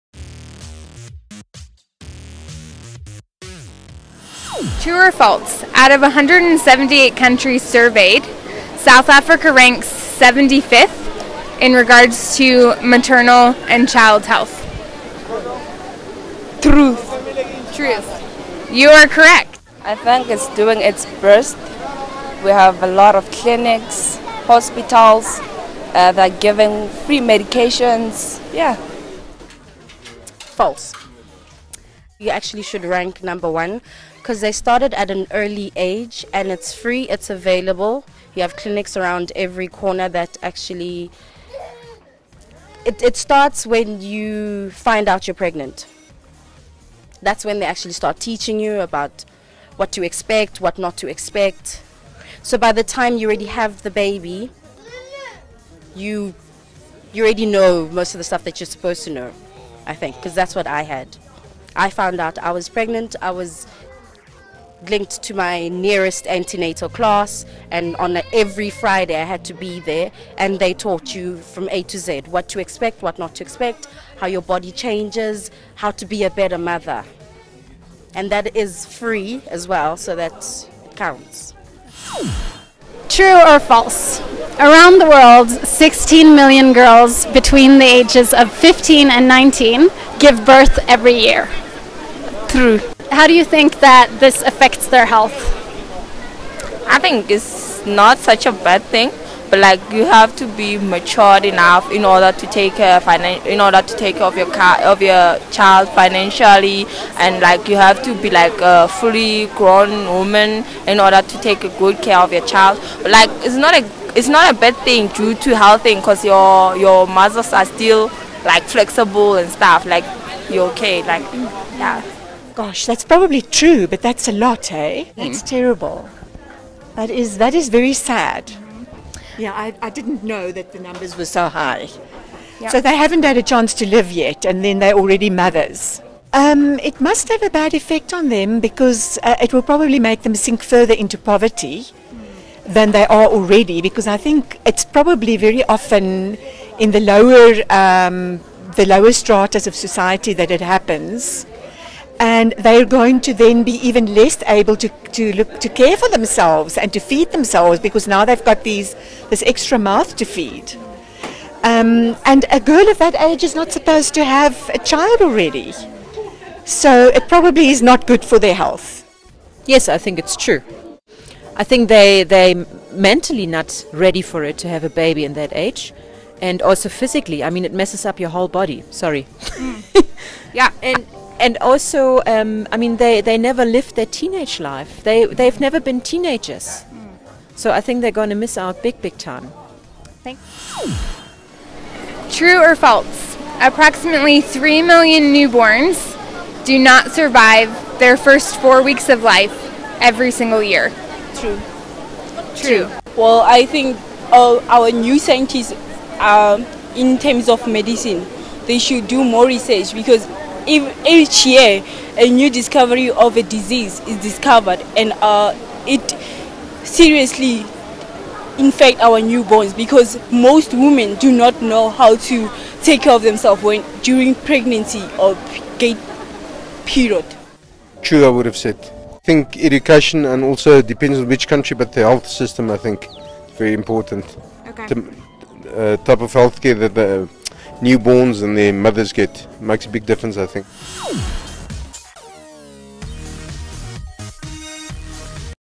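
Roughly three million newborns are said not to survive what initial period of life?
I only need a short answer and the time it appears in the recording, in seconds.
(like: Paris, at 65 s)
first four weeks, at 198 s.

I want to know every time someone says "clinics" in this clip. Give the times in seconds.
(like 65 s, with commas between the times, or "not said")
23 s, 38 s.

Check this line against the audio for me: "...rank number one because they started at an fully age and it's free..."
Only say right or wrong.
wrong.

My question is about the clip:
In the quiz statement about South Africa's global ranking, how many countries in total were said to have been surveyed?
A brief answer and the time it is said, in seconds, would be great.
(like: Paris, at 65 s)
178, at 6 s.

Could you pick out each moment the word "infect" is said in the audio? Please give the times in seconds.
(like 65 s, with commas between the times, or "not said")
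218 s.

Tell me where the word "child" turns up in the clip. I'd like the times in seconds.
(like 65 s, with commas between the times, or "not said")
13 s, 105 s, 112 s, 164 s.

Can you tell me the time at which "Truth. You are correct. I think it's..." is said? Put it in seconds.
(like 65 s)
17 s.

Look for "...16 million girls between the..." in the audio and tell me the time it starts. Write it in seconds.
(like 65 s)
85 s.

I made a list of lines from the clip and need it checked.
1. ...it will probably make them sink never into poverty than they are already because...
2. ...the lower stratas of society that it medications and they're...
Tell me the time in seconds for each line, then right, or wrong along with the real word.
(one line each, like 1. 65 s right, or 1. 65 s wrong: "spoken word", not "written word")
1. 139 s wrong: "further", not "never"
2. 148 s wrong: "happens", not "medications".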